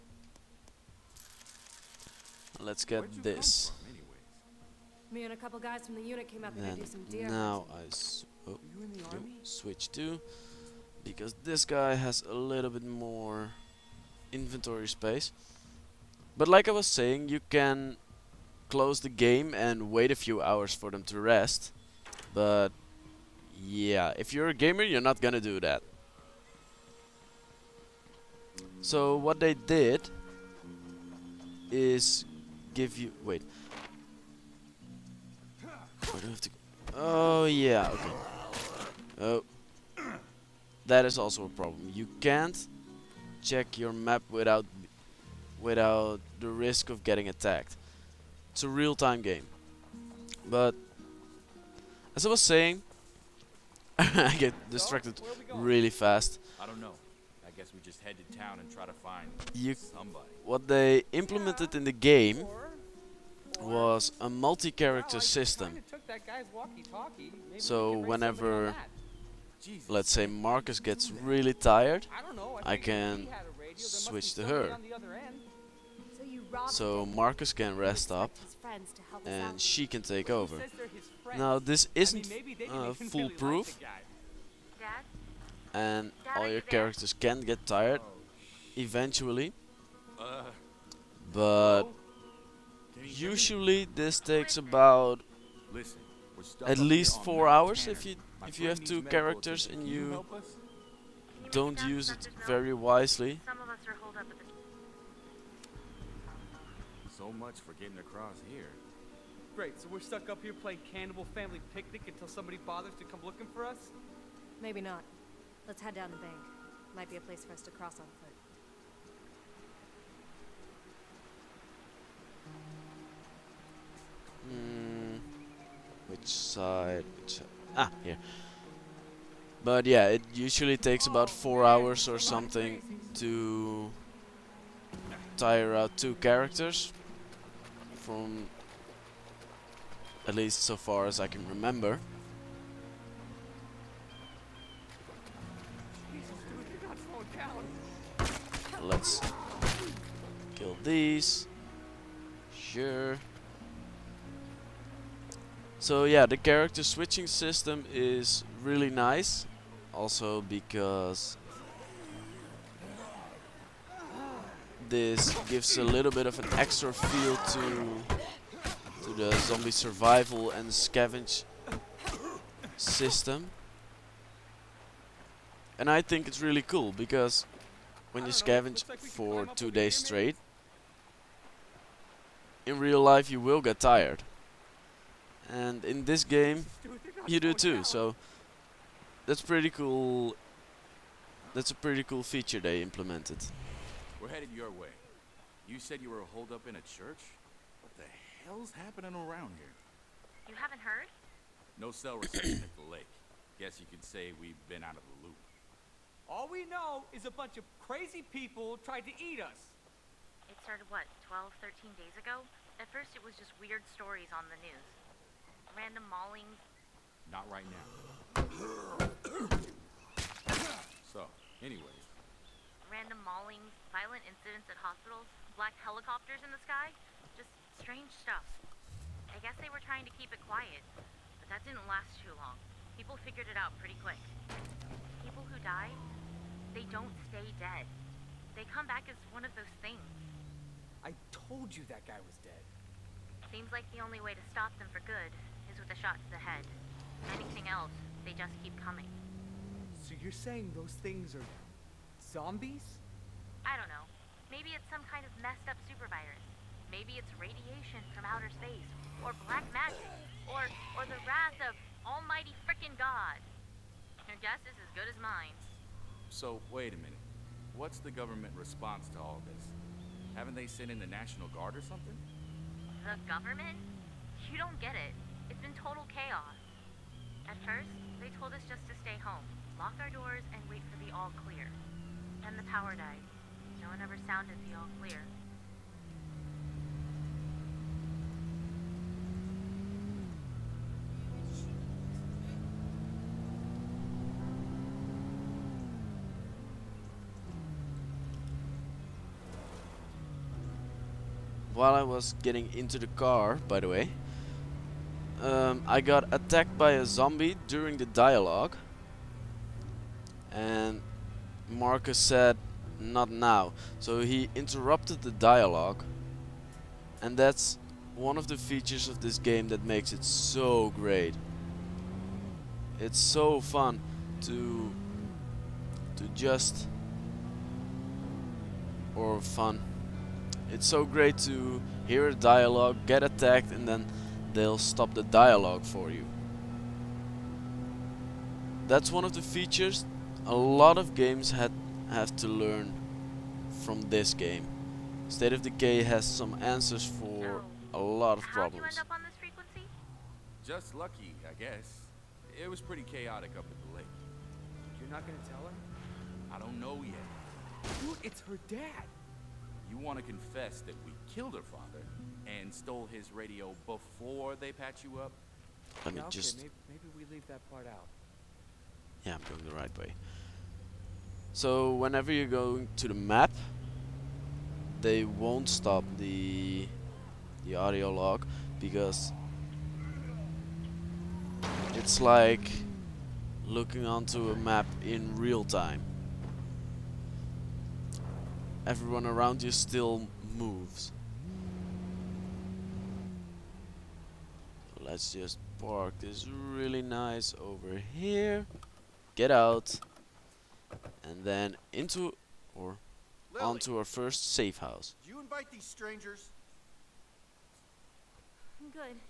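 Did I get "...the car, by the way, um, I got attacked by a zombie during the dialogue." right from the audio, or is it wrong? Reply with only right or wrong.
right.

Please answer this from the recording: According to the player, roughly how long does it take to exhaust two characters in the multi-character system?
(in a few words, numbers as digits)
4 hours.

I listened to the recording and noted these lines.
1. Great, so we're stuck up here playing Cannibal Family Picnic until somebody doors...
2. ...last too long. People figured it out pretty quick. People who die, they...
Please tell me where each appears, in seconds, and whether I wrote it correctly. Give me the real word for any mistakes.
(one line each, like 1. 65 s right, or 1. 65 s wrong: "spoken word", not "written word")
1. 109 s wrong: "bothers", not "doors"
2. 231 s right.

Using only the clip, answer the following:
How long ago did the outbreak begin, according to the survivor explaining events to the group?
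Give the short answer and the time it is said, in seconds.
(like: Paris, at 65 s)
12, 13 days, at 211 s.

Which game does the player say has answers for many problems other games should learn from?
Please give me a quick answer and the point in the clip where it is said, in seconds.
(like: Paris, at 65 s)
State of Decay, at 345 s.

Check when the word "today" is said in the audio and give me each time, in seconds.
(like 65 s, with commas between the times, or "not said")
not said.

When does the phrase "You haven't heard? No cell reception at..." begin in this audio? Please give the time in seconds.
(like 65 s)
200 s.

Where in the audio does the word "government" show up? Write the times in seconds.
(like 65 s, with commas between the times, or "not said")
268 s, 273 s.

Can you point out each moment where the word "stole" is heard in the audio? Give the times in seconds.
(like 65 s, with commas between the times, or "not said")
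362 s.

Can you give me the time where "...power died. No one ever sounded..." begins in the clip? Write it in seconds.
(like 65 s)
282 s.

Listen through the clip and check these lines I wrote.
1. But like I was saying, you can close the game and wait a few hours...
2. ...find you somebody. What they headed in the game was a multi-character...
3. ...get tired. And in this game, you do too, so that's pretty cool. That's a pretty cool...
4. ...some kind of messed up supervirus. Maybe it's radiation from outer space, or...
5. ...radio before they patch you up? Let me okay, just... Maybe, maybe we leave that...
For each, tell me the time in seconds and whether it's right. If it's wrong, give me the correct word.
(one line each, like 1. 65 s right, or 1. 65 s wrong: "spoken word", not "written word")
1. 16 s right
2. 58 s wrong: "implemented", not "headed"
3. 183 s right
4. 254 s right
5. 363 s right.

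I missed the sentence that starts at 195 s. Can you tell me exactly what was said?
You said you were holed up in a church?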